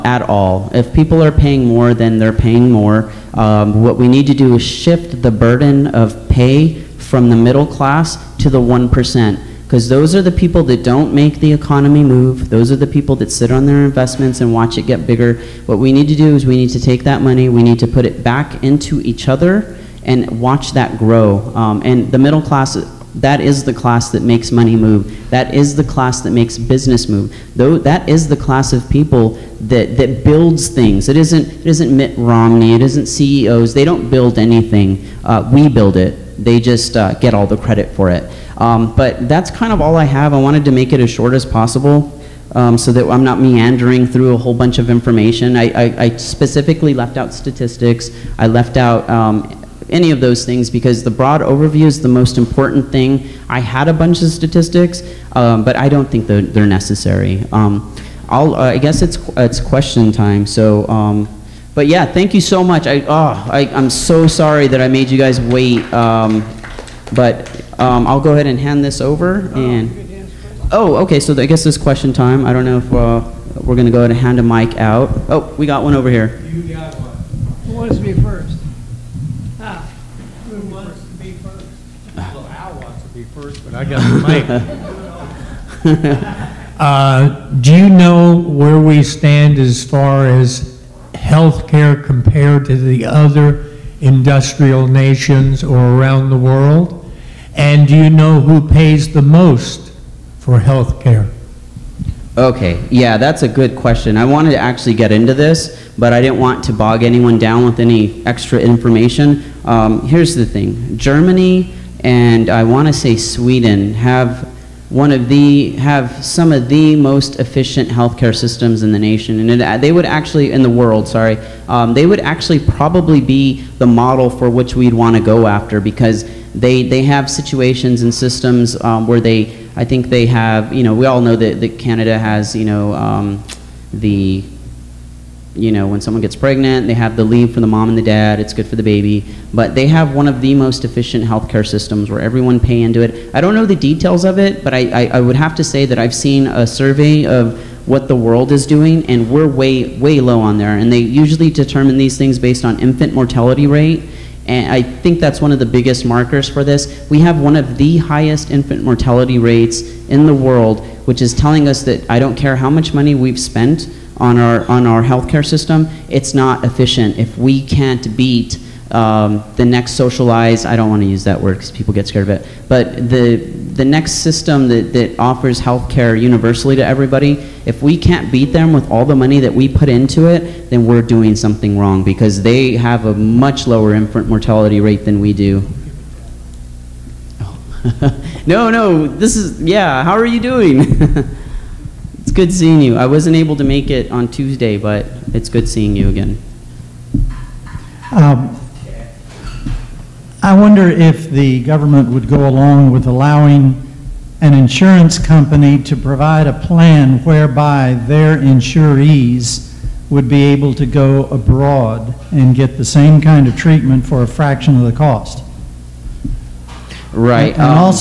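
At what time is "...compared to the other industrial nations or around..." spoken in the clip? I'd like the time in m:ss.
1:32.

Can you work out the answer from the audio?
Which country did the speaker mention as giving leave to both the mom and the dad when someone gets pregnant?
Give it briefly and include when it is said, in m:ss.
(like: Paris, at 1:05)
Canada, at 2:11.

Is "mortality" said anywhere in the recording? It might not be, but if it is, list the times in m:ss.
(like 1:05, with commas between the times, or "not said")
2:33, 2:38, 3:04.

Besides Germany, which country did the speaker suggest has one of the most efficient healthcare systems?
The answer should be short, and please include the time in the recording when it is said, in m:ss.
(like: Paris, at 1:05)
Sweden, at 1:53.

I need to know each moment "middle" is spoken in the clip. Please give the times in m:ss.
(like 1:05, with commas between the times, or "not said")
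0:07, 0:22.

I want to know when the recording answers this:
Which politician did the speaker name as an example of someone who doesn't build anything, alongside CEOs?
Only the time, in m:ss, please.
0:31.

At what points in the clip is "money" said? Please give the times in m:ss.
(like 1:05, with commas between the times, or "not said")
0:17, 0:24, 2:42, 2:59.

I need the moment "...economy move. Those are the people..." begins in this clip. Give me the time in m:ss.
0:11.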